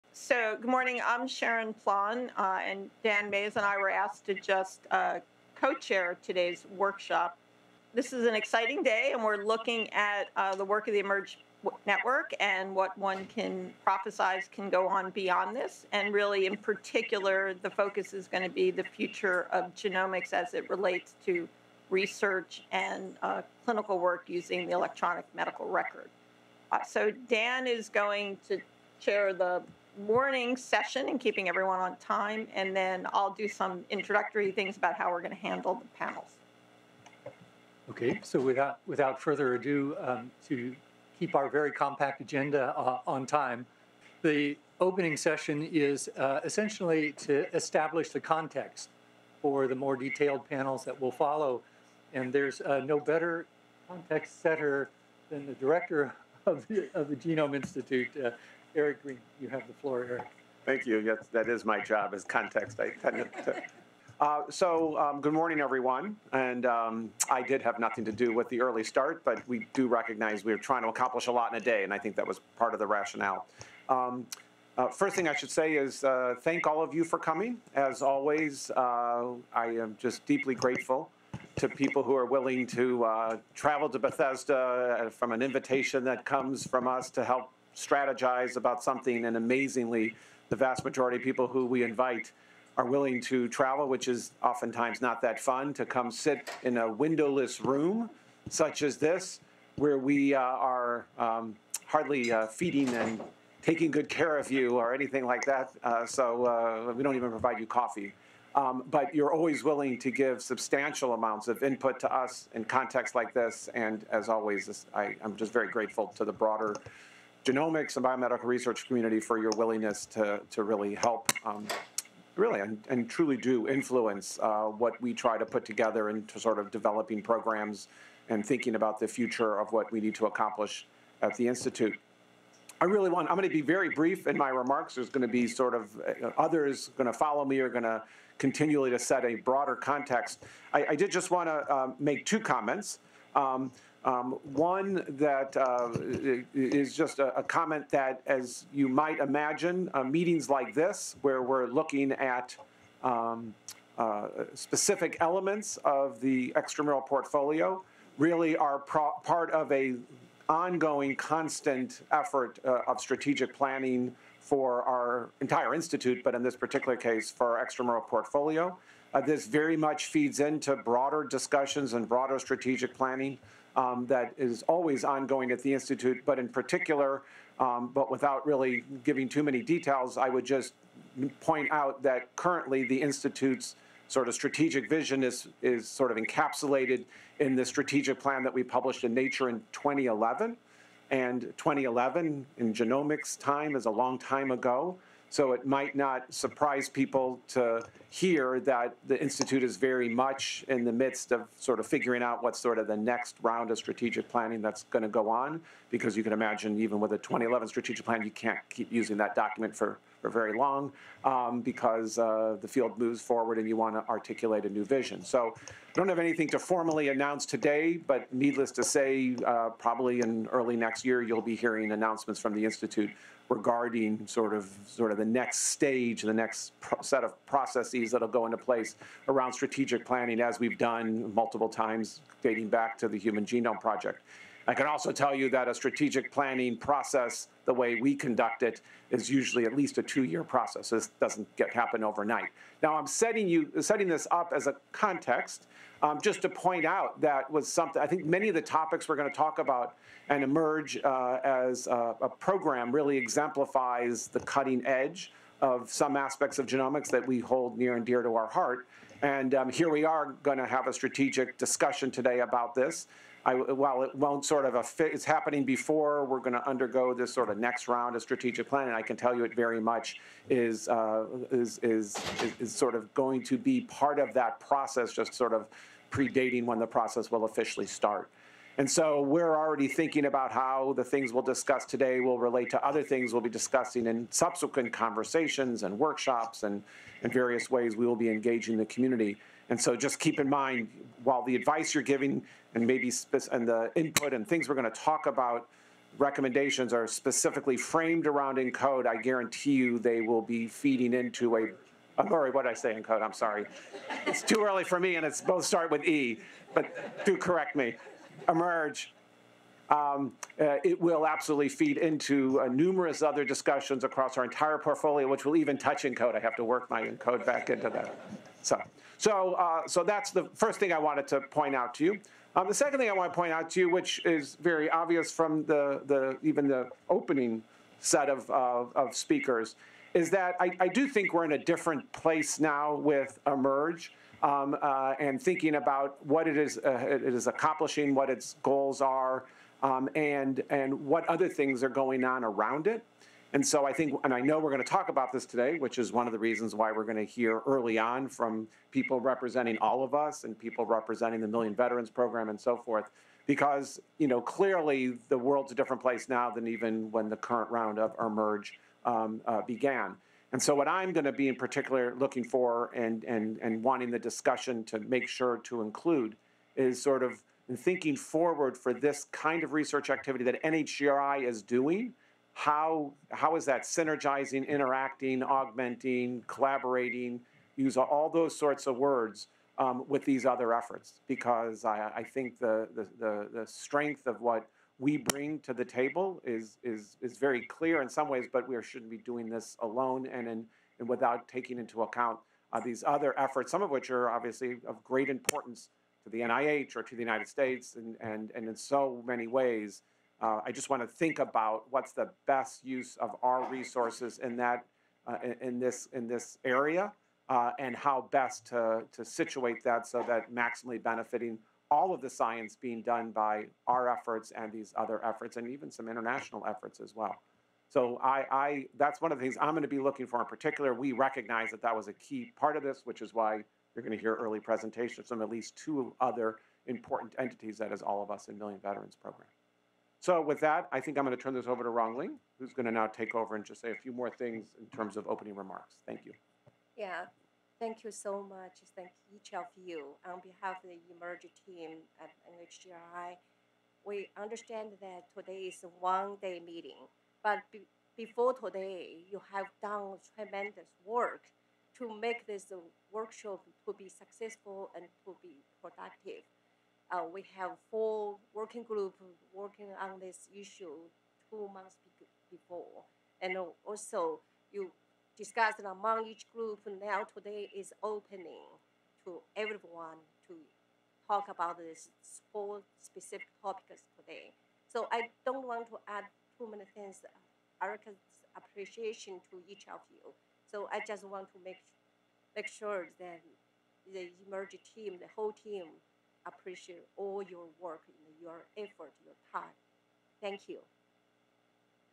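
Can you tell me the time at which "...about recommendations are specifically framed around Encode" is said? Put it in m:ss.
4:55.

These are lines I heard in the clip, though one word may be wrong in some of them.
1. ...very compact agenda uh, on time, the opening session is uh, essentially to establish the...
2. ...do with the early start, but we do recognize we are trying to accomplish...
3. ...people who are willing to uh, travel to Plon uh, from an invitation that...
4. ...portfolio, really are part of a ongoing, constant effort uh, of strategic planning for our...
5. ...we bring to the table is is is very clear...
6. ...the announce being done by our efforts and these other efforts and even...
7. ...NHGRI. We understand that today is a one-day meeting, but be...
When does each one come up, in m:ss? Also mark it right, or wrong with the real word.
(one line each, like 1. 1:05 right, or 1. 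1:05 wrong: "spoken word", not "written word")
1. 0:41 right
2. 1:08 right
3. 1:21 wrong: "Bethesda", not "Plon"
4. 2:37 right
5. 6:24 right
6. 6:52 wrong: "science", not "announce"
7. 7:22 right.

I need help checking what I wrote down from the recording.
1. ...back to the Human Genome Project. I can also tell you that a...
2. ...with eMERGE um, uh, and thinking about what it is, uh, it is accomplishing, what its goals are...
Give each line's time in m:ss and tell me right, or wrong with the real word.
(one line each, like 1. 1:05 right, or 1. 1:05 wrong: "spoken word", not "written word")
1. 3:52 right
2. 5:32 right.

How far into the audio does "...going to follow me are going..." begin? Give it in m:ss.
2:16.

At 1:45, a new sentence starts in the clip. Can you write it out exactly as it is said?
Uh, so uh, we don't even provide you coffee.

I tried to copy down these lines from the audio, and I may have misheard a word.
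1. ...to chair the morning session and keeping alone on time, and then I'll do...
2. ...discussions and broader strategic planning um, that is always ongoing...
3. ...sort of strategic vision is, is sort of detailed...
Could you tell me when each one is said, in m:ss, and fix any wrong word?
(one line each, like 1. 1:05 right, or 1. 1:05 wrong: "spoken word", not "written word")
1. 0:28 wrong: "everyone", not "alone"
2. 2:51 right
3. 3:04 wrong: "encapsulated", not "detailed".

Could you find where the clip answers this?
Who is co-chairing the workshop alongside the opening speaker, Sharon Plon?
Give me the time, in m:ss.
0:03.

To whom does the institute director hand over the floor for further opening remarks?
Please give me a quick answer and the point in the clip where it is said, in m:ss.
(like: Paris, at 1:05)
Rongling, at 7:11.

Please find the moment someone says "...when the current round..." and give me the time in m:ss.
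5:57.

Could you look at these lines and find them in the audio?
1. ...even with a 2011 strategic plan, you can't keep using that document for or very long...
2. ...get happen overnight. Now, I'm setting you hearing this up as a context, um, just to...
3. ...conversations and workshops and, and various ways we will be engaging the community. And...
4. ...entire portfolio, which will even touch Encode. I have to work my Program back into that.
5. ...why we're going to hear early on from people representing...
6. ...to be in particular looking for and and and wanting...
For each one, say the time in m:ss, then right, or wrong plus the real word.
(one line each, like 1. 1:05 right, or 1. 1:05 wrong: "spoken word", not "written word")
1. 3:26 right
2. 4:01 wrong: "setting", not "hearing"
3. 4:44 right
4. 5:14 wrong: "Encode", not "Program"
5. 5:46 right
6. 6:01 right.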